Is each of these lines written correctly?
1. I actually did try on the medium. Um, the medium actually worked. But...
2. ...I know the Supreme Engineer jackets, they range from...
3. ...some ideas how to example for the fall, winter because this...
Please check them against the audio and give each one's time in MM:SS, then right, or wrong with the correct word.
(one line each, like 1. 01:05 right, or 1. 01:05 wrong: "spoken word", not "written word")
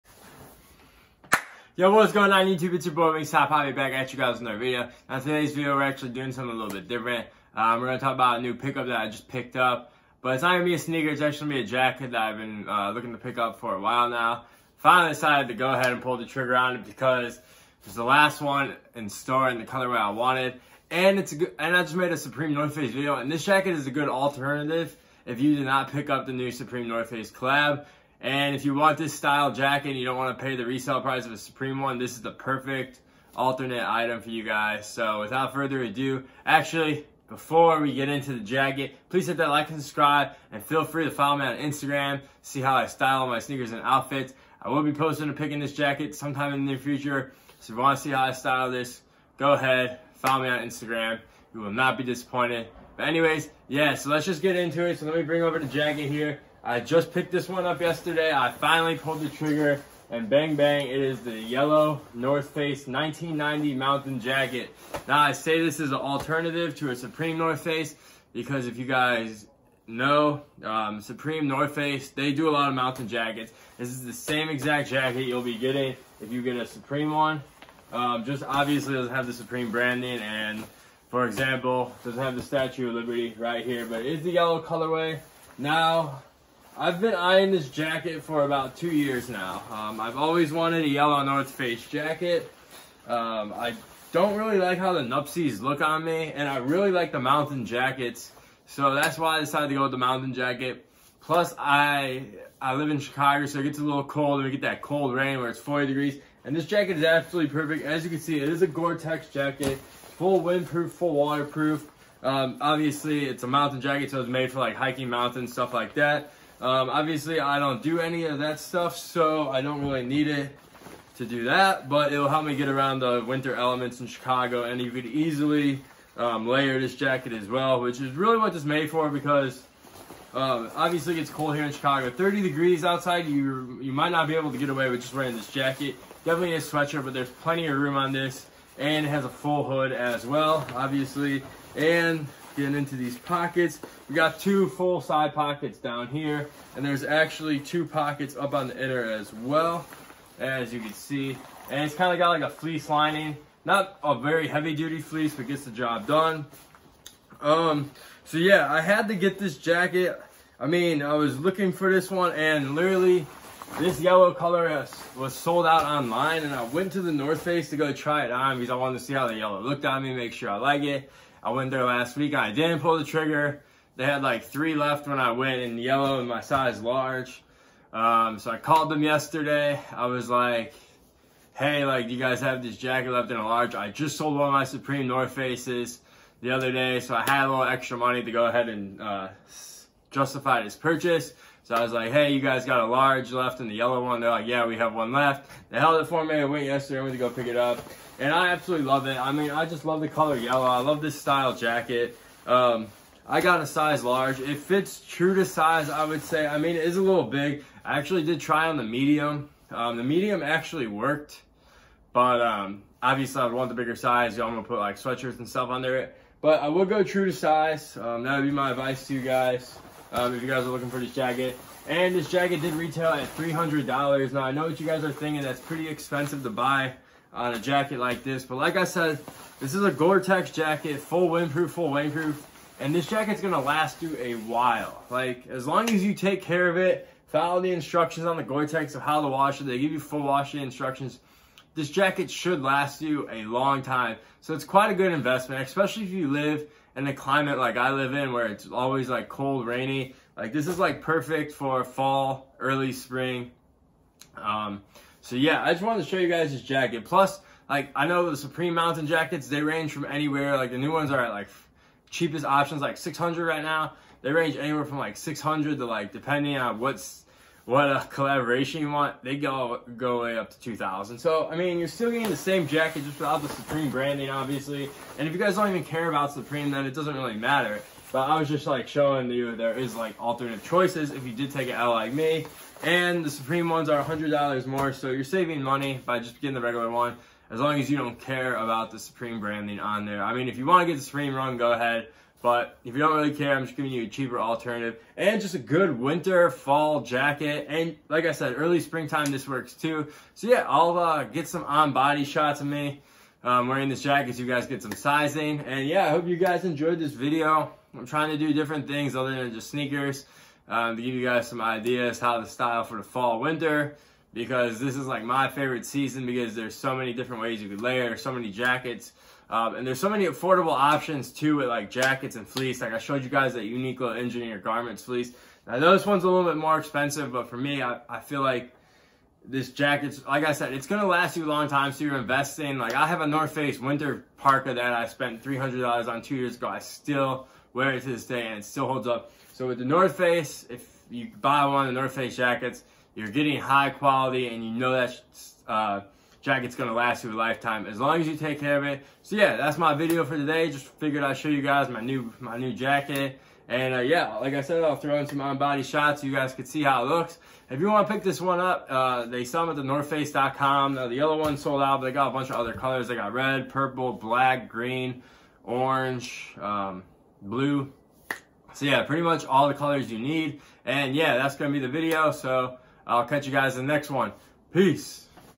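1. 03:27 right
2. 04:17 wrong: "Mountain", not "Engineer"
3. 05:11 wrong: "style", not "example".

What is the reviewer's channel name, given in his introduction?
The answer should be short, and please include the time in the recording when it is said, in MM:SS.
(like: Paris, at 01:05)
Wingstop Papi, at 00:03.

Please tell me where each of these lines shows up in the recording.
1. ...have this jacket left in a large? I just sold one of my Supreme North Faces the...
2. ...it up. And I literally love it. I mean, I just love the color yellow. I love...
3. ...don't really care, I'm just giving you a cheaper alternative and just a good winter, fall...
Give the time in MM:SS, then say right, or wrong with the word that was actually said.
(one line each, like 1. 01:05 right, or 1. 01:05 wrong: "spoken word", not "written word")
1. 03:02 right
2. 03:17 wrong: "absolutely", not "literally"
3. 04:52 right.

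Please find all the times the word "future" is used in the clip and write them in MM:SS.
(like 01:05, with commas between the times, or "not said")
00:46.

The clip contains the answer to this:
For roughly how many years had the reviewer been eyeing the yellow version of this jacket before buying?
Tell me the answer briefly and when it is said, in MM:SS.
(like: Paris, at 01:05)
2 years, at 01:28.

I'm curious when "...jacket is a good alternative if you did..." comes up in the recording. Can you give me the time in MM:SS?
00:23.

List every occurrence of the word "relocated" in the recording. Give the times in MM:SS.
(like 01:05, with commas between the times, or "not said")
not said.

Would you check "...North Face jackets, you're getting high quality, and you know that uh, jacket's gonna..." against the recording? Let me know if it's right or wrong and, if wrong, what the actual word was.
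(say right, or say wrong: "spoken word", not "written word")
right.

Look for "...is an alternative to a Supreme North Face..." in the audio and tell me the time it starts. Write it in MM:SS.
01:05.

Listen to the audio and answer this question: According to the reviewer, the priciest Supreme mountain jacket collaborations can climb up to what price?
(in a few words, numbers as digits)
2,000.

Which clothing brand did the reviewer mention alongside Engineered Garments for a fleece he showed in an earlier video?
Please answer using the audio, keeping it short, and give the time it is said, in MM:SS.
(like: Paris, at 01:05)
Uniqlo, at 05:23.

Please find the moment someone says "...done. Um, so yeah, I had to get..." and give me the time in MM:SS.
02:36.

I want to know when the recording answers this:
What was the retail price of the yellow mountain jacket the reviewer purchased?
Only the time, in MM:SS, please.
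03:42.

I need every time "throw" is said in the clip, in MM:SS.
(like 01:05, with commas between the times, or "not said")
05:54.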